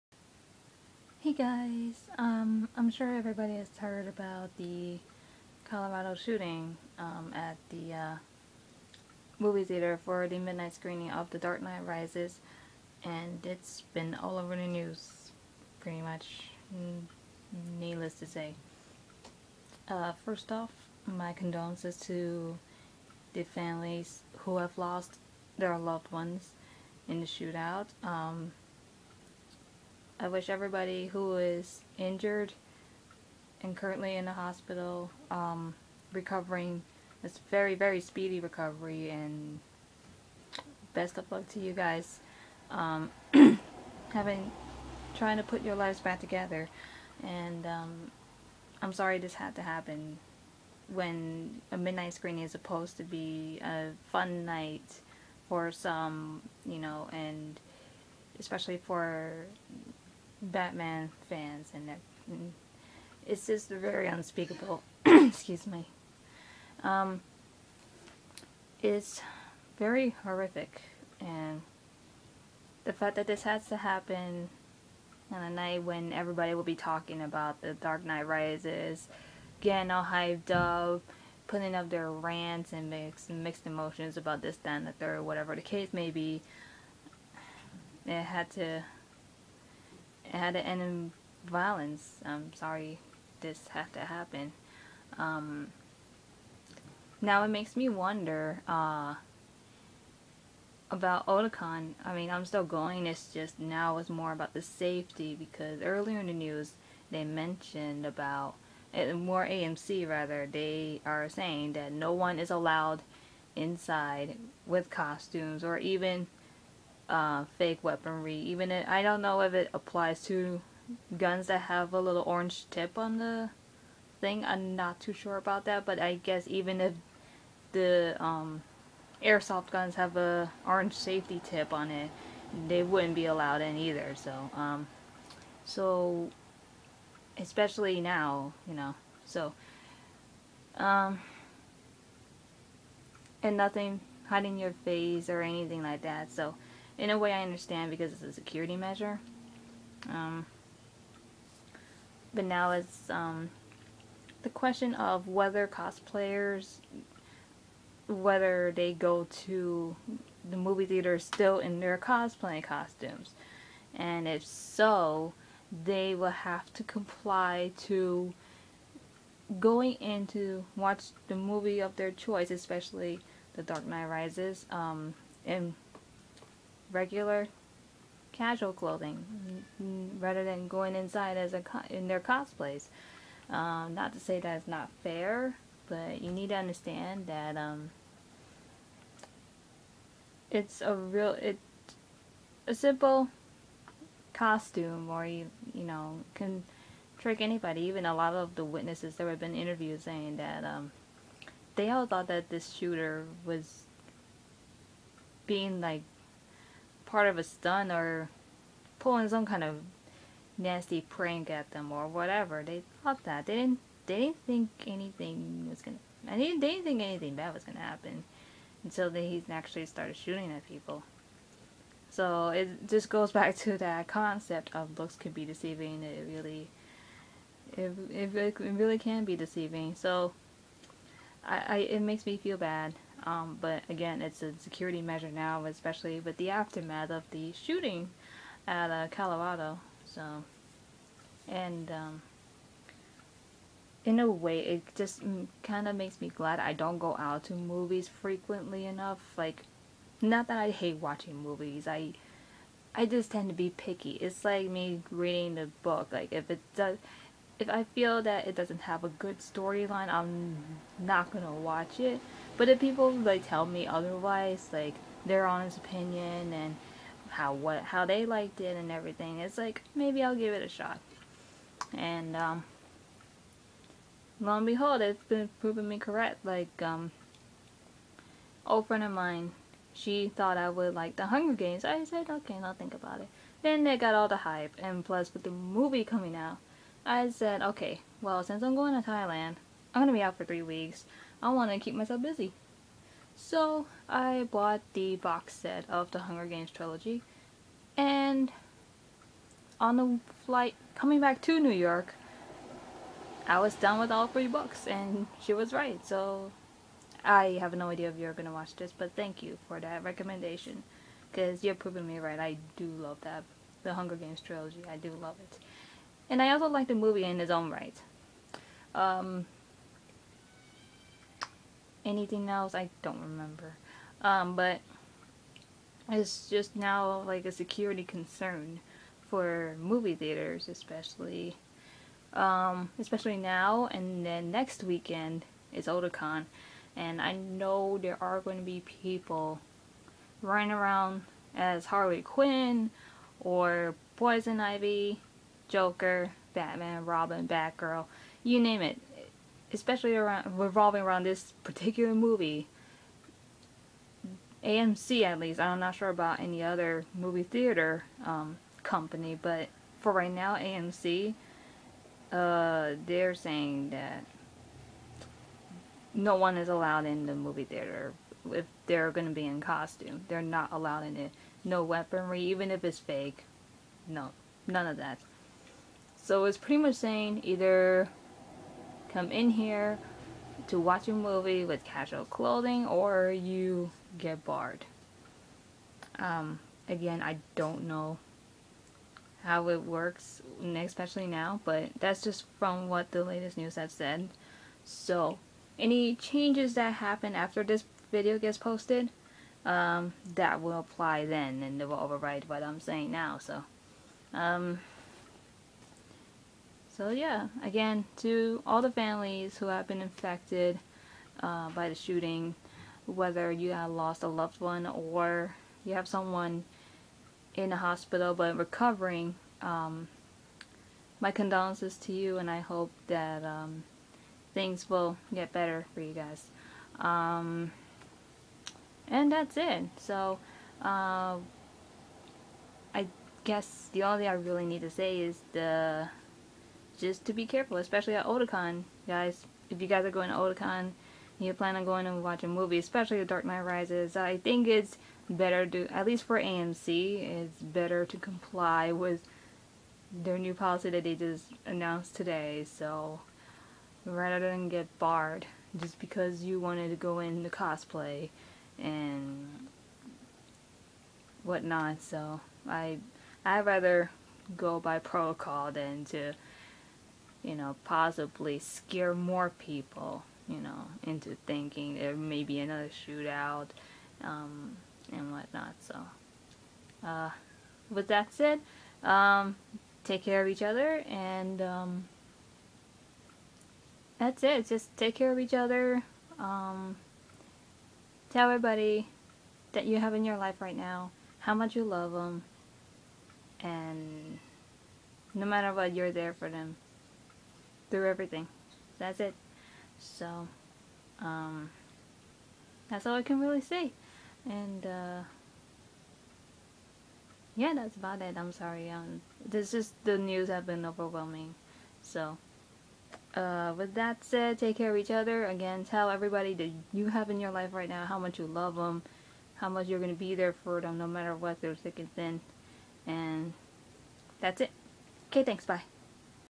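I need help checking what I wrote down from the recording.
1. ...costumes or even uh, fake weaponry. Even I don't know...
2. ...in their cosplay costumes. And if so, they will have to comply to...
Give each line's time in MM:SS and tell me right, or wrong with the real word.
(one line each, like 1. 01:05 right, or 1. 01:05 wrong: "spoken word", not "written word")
1. 01:54 right
2. 02:41 right.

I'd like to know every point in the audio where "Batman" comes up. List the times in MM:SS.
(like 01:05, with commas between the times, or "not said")
01:00, 05:46.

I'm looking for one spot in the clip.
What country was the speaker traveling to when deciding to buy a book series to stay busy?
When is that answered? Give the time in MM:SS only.
04:49.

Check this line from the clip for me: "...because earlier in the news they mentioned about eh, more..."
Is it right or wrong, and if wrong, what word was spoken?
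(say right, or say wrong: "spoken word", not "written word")
right.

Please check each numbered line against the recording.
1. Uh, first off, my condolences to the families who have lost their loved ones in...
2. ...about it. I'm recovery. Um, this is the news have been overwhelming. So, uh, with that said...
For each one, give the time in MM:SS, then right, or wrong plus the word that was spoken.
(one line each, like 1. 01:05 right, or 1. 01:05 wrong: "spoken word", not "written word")
1. 00:19 right
2. 08:27 wrong: "sorry", not "recovery".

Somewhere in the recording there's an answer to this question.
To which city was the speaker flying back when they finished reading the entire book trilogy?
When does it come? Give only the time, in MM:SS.
05:01.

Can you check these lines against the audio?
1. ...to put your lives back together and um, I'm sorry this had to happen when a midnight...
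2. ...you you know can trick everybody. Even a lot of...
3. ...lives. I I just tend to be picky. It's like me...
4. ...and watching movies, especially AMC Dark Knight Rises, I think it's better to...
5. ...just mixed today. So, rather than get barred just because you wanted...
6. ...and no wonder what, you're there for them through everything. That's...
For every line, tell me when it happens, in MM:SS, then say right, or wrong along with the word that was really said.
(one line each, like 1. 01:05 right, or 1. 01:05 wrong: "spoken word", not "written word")
1. 00:45 right
2. 03:15 wrong: "anybody", not "everybody"
3. 04:11 wrong: "movies", not "lives"
4. 07:22 wrong: "The", not "AMC"
5. 07:31 wrong: "announced", not "mixed"
6. 08:13 wrong: "matter", not "wonder".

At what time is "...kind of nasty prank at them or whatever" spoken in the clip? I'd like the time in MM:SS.
03:29.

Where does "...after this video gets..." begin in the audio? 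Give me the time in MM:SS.
06:37.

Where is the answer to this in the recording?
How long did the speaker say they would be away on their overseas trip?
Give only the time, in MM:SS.
04:50.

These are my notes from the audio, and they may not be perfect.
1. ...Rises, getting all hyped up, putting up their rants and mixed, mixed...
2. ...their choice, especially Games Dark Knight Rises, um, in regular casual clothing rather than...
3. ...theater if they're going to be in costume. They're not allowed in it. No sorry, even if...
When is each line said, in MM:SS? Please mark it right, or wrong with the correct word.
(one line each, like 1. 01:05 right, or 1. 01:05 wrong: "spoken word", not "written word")
1. 01:18 right
2. 02:51 wrong: "The", not "Games"
3. 06:07 wrong: "weaponry", not "sorry".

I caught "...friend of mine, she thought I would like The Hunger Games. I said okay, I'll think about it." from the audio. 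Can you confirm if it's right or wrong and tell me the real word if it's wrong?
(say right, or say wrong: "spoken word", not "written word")
right.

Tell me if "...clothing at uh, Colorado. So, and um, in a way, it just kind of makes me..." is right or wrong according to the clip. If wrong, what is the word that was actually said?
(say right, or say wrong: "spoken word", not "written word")
wrong: "shooting", not "clothing".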